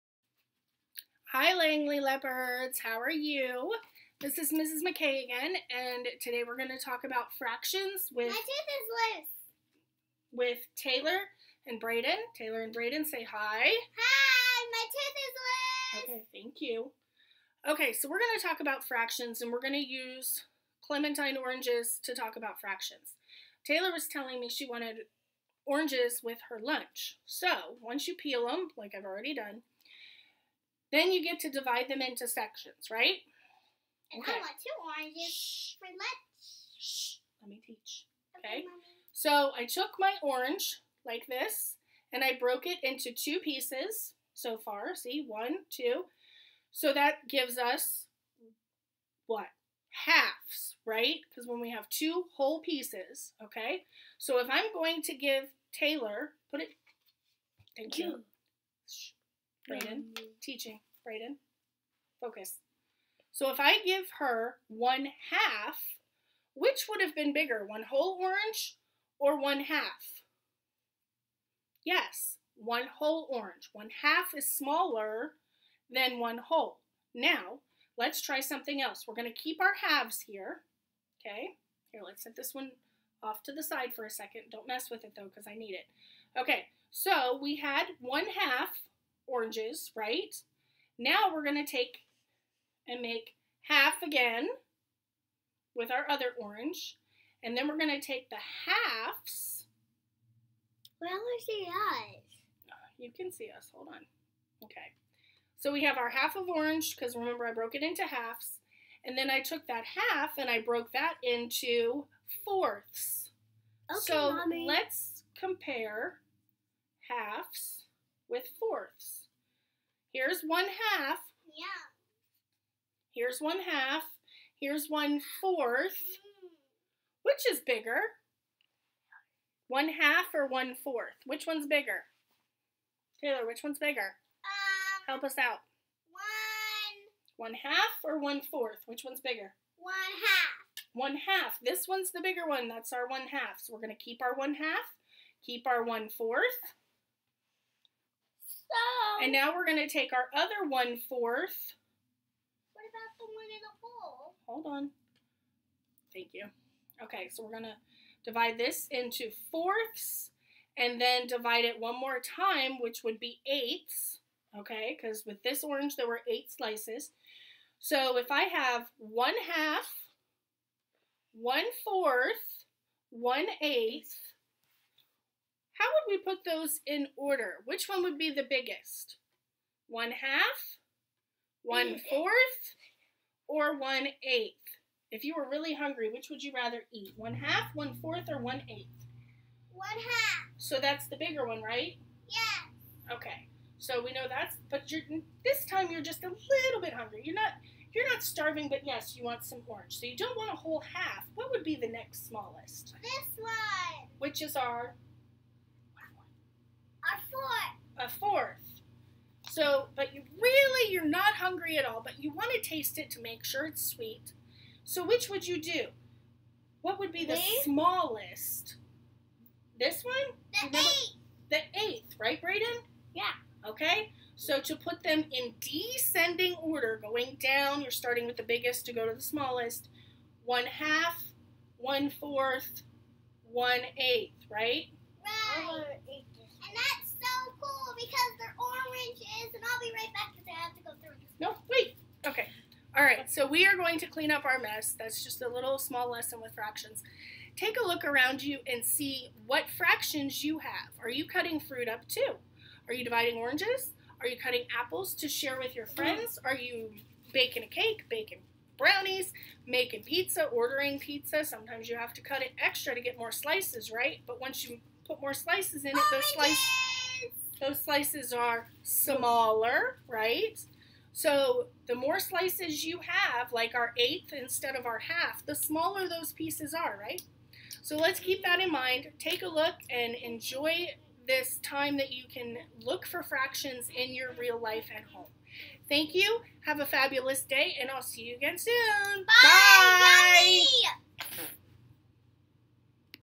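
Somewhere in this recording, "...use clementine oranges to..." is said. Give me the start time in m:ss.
0:19.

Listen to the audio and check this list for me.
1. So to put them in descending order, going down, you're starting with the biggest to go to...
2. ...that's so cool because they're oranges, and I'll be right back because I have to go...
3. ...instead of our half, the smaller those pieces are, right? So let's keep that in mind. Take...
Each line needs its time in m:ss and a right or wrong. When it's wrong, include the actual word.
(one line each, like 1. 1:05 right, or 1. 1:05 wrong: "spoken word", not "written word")
1. 3:44 right
2. 3:56 right
3. 4:34 right.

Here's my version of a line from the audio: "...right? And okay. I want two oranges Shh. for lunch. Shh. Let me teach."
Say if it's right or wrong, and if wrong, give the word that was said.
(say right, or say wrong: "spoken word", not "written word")
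right.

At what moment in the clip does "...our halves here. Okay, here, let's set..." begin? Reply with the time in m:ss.
1:19.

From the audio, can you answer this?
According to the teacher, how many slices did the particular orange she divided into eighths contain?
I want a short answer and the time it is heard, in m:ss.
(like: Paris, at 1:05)
8, at 2:46.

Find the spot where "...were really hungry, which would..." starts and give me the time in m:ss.
3:05.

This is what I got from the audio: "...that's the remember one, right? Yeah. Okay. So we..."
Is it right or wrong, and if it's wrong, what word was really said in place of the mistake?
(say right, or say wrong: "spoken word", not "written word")
wrong: "bigger", not "remember".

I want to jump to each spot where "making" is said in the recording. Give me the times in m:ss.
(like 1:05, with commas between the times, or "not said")
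4:19.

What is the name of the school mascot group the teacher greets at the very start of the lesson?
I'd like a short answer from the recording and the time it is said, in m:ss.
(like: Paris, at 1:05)
Langley Leopards, at 0:01.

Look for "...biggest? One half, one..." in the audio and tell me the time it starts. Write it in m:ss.
2:58.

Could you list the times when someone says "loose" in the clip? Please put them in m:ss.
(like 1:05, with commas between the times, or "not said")
0:09, 0:15.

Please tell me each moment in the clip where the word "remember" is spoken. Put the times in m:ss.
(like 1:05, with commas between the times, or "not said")
1:47, 3:40.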